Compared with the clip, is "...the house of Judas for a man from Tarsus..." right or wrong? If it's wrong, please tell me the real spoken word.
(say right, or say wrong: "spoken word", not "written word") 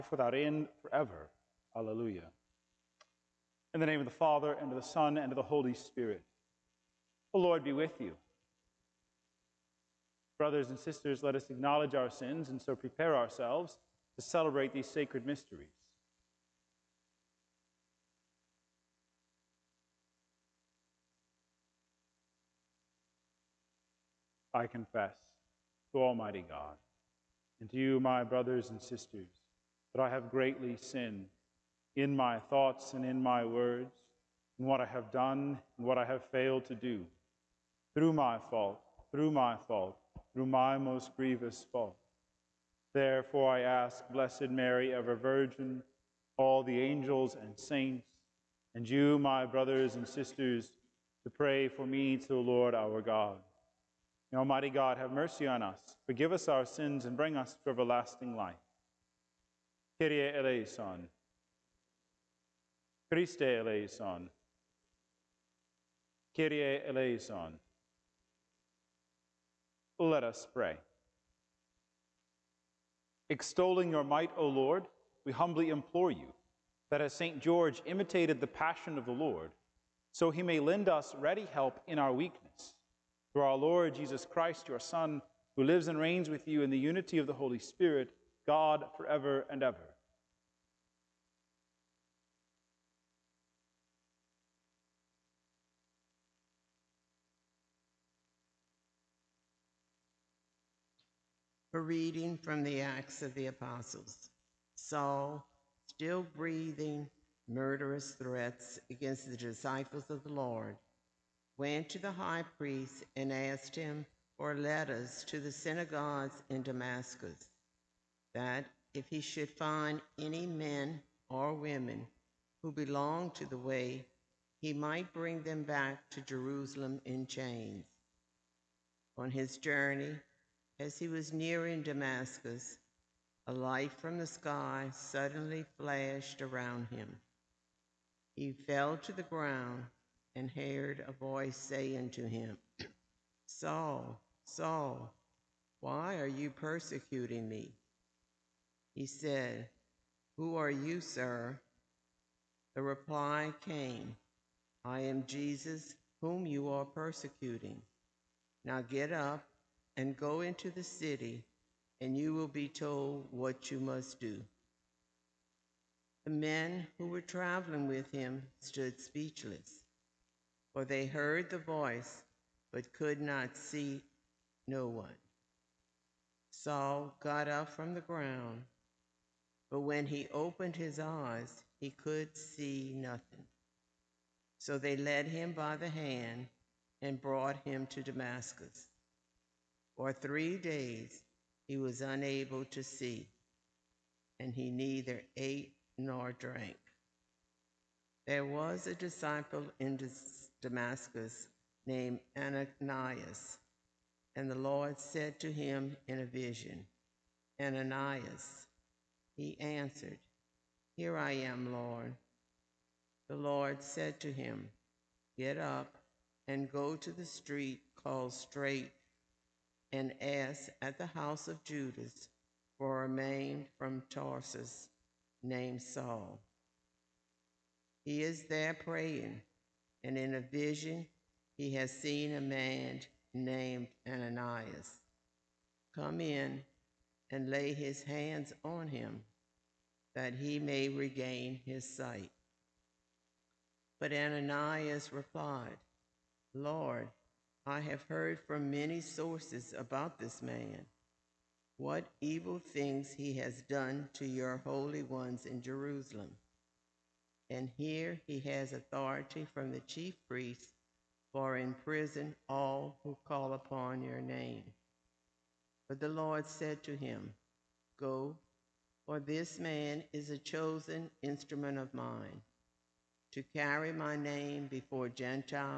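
right.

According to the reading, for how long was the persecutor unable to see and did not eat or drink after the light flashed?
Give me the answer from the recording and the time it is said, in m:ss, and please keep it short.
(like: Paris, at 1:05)
3 days, at 3:10.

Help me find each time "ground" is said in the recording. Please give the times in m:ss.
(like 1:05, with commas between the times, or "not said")
2:19, 2:58.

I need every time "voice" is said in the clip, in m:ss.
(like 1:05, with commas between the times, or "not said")
2:21, 2:51.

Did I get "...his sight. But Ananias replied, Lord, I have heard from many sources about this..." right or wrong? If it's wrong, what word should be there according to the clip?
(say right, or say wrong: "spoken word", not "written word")
right.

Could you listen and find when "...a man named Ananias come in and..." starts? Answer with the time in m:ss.
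3:52.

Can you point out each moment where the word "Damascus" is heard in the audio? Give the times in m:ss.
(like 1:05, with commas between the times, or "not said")
1:56, 2:11, 3:08, 3:20.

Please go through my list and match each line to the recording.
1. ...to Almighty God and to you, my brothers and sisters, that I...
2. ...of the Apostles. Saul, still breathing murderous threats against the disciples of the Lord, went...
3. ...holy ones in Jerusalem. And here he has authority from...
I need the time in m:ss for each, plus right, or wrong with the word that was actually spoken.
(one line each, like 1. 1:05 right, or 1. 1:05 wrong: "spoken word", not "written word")
1. 0:25 right
2. 1:43 right
3. 4:14 right.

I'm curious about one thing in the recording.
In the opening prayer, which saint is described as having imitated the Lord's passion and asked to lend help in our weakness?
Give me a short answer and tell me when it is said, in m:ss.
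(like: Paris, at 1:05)
St. George, at 1:17.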